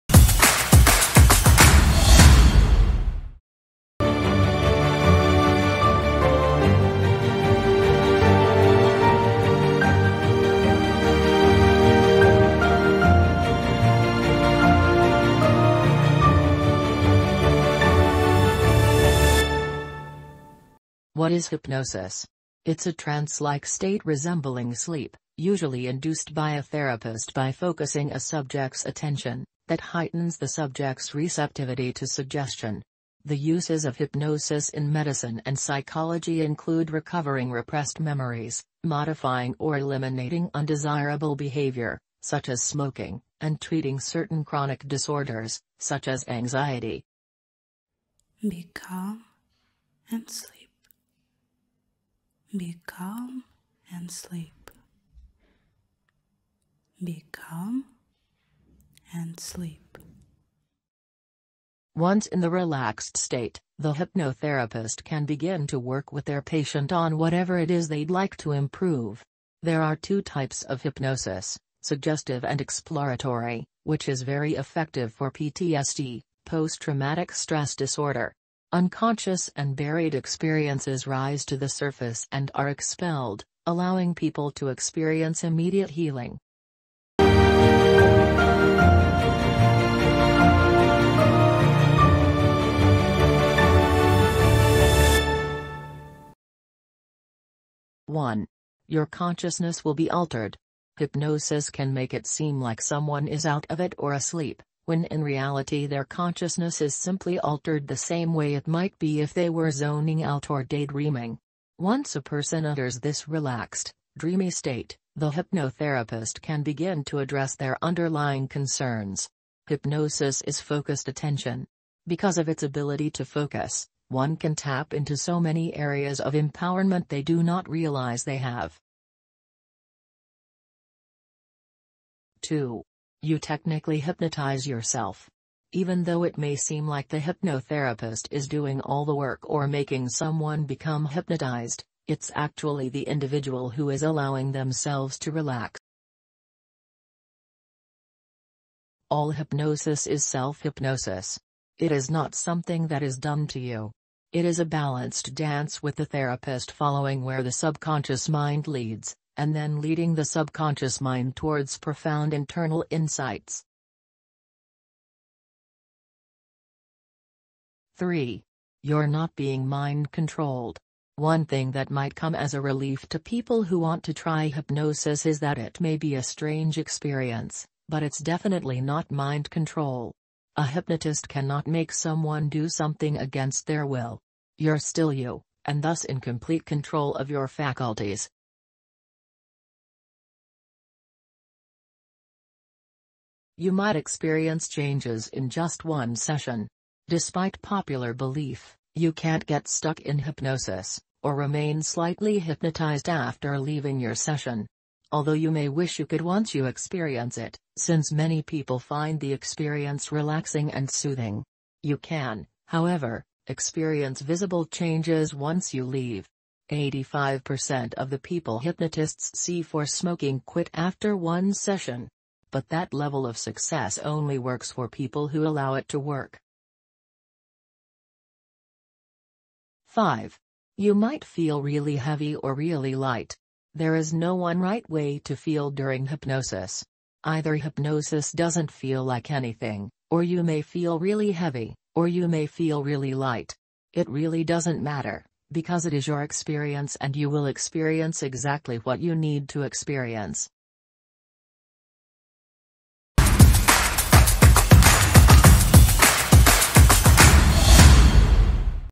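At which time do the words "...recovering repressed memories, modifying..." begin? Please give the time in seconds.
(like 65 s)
36 s.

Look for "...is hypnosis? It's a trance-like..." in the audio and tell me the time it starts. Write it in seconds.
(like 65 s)
21 s.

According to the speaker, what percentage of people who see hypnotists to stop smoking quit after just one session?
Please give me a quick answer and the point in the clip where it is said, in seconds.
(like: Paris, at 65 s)
85%, at 216 s.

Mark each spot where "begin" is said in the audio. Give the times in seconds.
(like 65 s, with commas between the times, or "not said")
65 s, 116 s.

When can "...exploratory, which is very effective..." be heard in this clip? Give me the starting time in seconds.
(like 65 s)
72 s.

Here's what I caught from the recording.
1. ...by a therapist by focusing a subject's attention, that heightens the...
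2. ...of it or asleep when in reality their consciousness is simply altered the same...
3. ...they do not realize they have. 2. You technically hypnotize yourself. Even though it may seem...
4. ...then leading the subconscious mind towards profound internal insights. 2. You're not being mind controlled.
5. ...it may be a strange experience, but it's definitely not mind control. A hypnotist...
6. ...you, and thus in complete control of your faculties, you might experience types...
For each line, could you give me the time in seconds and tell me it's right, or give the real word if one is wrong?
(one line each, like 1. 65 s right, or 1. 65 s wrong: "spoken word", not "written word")
1. 26 s right
2. 103 s right
3. 127 s right
4. 159 s wrong: "3", not "2"
5. 175 s right
6. 185 s wrong: "changes", not "types".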